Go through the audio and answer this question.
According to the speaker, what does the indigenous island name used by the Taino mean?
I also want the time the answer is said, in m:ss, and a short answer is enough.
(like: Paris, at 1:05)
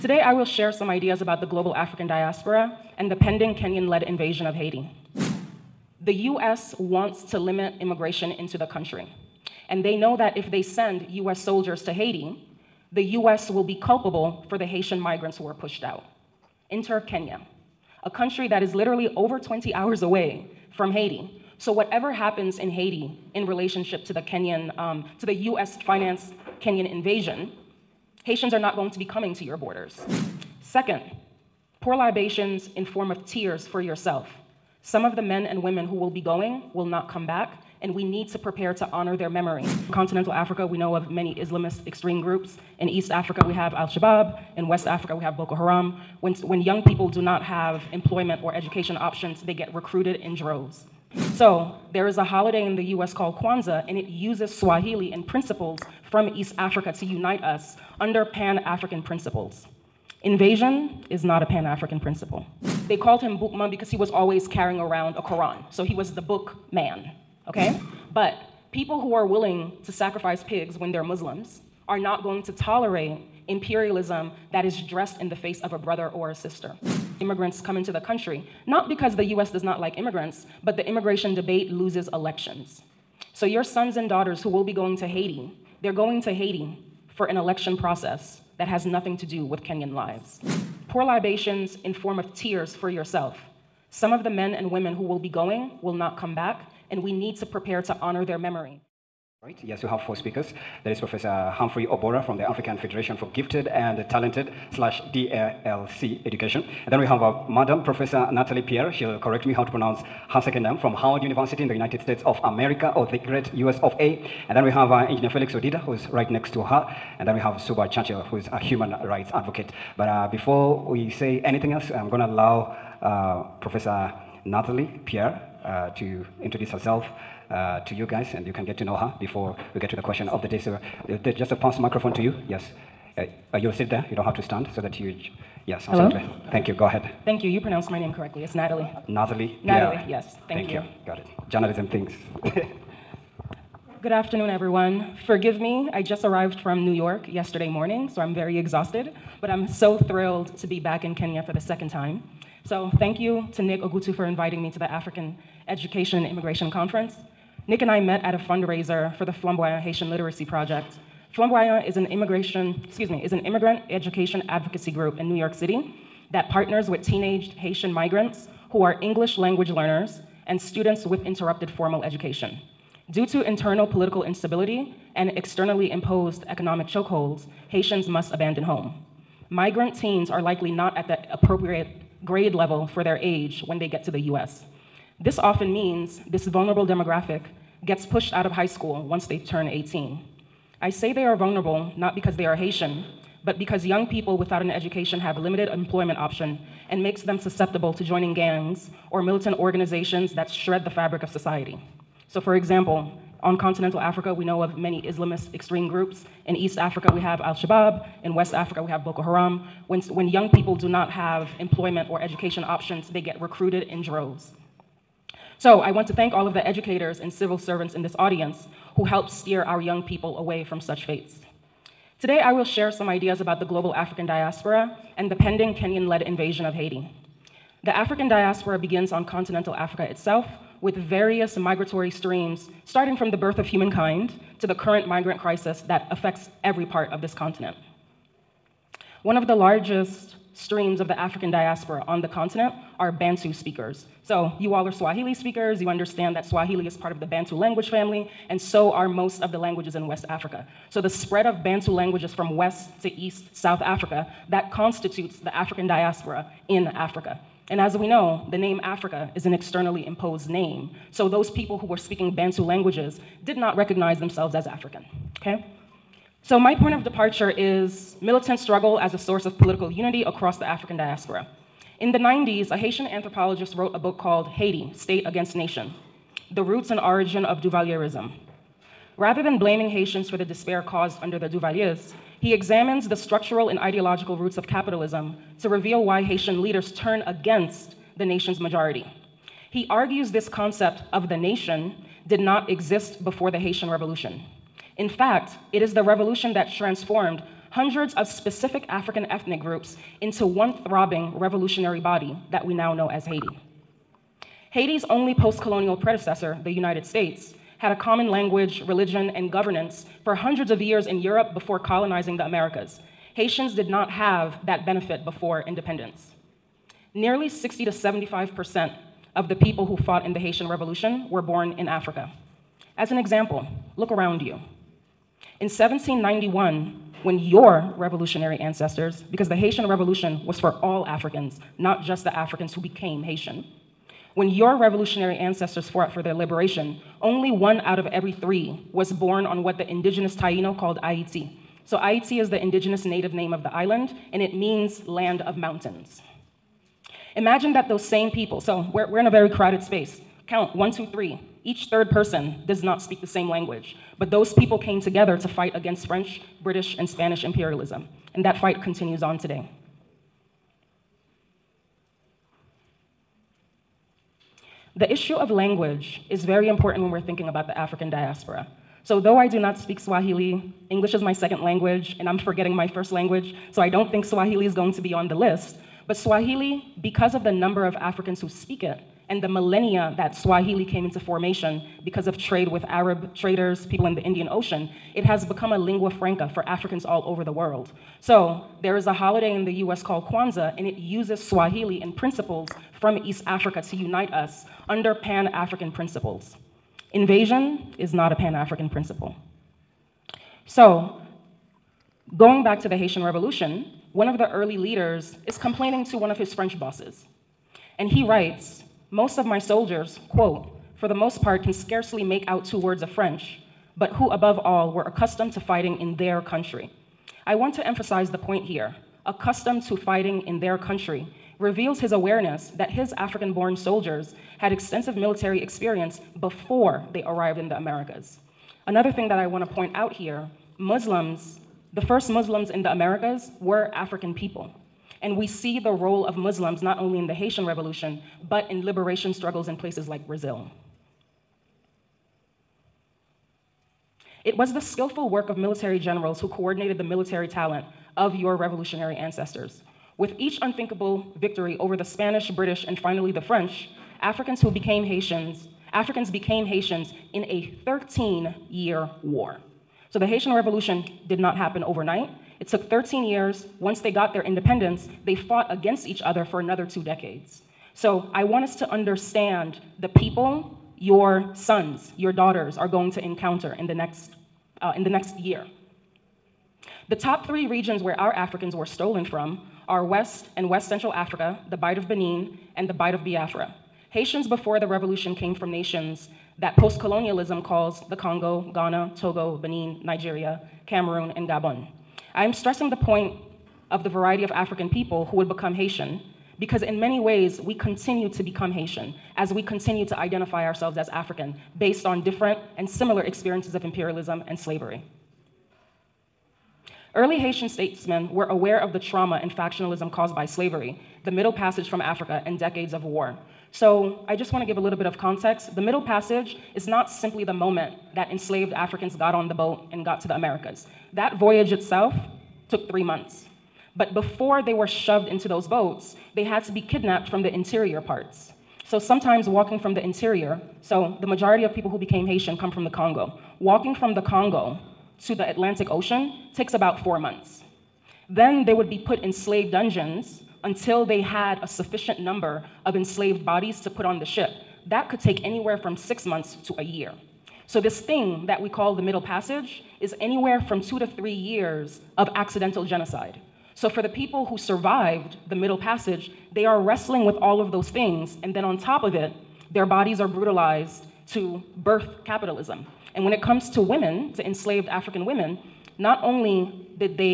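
land of mountains, at 5:45.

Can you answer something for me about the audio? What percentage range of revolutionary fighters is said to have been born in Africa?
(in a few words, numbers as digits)
60 to 75 percent.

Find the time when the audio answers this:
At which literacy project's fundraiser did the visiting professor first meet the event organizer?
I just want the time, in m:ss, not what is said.
2:39.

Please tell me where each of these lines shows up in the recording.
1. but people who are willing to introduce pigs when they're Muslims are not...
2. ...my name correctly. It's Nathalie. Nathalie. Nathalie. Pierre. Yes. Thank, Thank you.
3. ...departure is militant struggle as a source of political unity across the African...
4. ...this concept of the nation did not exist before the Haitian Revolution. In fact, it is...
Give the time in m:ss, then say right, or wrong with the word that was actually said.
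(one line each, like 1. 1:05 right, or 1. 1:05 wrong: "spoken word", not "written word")
1. 1:08 wrong: "sacrifice", not "introduce"
2. 2:17 right
3. 4:27 right
4. 4:50 right.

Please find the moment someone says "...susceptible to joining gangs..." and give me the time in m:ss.
3:17.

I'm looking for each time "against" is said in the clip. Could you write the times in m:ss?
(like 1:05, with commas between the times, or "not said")
4:35, 4:47, 5:55, 7:45.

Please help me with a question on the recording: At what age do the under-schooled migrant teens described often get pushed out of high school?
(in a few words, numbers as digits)
18.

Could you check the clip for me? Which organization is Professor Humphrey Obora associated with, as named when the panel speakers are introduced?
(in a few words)
African Federation for Gifted and Talented.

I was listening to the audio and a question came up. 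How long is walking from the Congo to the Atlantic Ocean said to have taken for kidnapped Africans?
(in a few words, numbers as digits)
four months.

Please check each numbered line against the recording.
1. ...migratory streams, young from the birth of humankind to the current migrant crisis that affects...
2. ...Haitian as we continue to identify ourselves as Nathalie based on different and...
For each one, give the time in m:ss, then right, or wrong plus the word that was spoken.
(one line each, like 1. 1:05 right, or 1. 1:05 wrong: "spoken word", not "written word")
1. 3:51 wrong: "starting", not "young"
2. 8:18 wrong: "African", not "Nathalie".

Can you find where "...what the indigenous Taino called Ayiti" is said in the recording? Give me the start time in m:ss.
5:39.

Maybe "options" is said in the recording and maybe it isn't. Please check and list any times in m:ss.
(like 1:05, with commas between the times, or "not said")
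0:48, 3:16, 3:32.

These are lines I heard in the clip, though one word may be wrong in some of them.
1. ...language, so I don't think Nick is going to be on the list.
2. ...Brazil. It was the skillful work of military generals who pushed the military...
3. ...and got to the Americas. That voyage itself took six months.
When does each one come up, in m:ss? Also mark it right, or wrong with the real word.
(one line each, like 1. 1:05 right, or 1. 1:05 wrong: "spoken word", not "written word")
1. 6:13 wrong: "Swahili", not "Nick"
2. 7:20 wrong: "coordinated", not "pushed"
3. 8:39 wrong: "three", not "six".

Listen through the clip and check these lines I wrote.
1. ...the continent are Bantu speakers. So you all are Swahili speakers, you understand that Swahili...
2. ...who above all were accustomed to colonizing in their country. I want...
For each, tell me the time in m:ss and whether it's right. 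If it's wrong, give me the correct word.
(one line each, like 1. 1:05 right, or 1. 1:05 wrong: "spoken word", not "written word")
1. 4:02 right
2. 6:54 wrong: "fighting", not "colonizing".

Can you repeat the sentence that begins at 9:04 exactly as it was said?
That could take anywhere from six months to a year.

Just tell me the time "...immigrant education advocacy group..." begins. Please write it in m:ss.
2:43.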